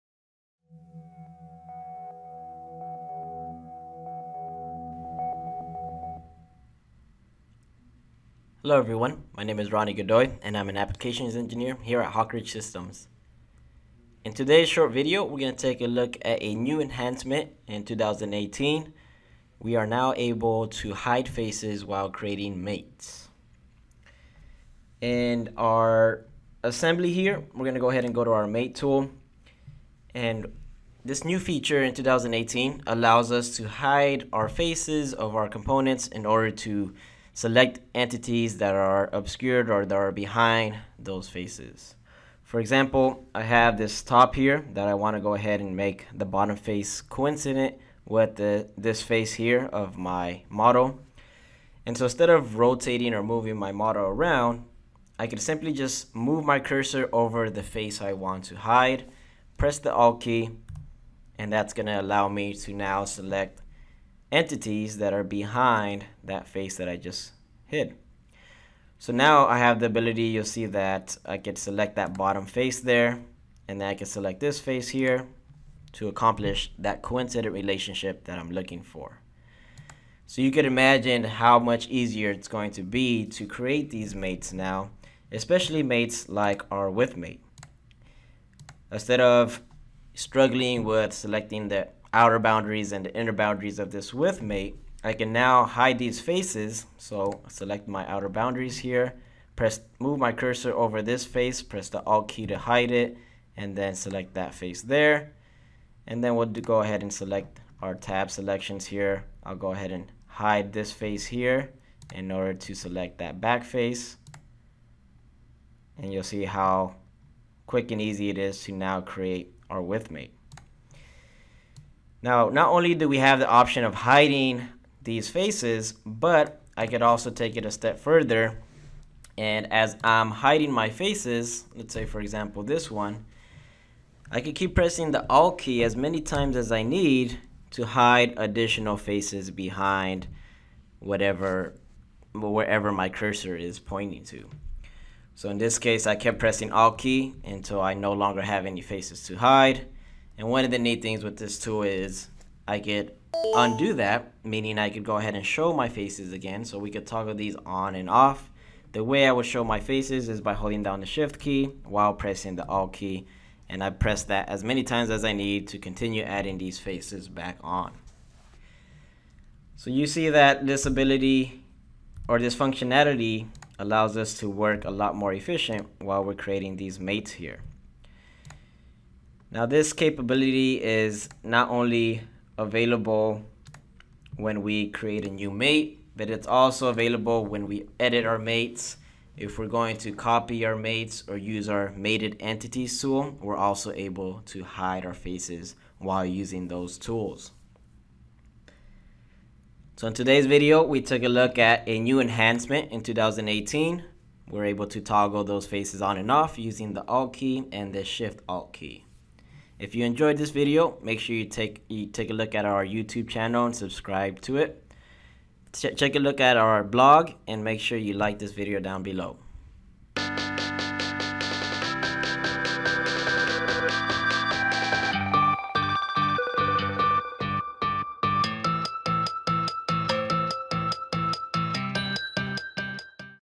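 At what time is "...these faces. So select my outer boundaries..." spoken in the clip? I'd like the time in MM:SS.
01:35.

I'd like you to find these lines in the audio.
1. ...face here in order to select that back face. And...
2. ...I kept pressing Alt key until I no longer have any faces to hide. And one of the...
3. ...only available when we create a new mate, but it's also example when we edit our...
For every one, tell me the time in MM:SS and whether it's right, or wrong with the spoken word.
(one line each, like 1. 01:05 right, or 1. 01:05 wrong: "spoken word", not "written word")
1. 01:50 right
2. 02:26 right
3. 03:01 wrong: "available", not "example".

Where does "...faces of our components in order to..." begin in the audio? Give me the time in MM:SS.
00:34.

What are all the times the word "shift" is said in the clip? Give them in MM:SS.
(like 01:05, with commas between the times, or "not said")
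02:41, 03:28.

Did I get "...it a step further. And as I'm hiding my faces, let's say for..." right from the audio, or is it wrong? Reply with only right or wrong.
right.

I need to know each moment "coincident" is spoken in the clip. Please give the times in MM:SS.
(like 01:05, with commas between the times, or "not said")
00:47, 01:17.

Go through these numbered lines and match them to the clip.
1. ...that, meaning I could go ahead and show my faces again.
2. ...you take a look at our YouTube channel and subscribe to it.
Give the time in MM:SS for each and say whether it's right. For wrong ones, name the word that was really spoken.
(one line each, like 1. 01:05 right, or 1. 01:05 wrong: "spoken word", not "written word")
1. 02:33 right
2. 03:31 right.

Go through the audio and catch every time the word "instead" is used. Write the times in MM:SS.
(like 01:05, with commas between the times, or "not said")
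00:52, 01:28.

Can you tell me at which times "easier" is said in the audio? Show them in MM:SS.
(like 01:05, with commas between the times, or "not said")
01:21.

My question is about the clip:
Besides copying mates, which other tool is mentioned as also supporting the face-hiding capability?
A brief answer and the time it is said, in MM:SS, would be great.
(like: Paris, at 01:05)
Mated entities tool, at 03:11.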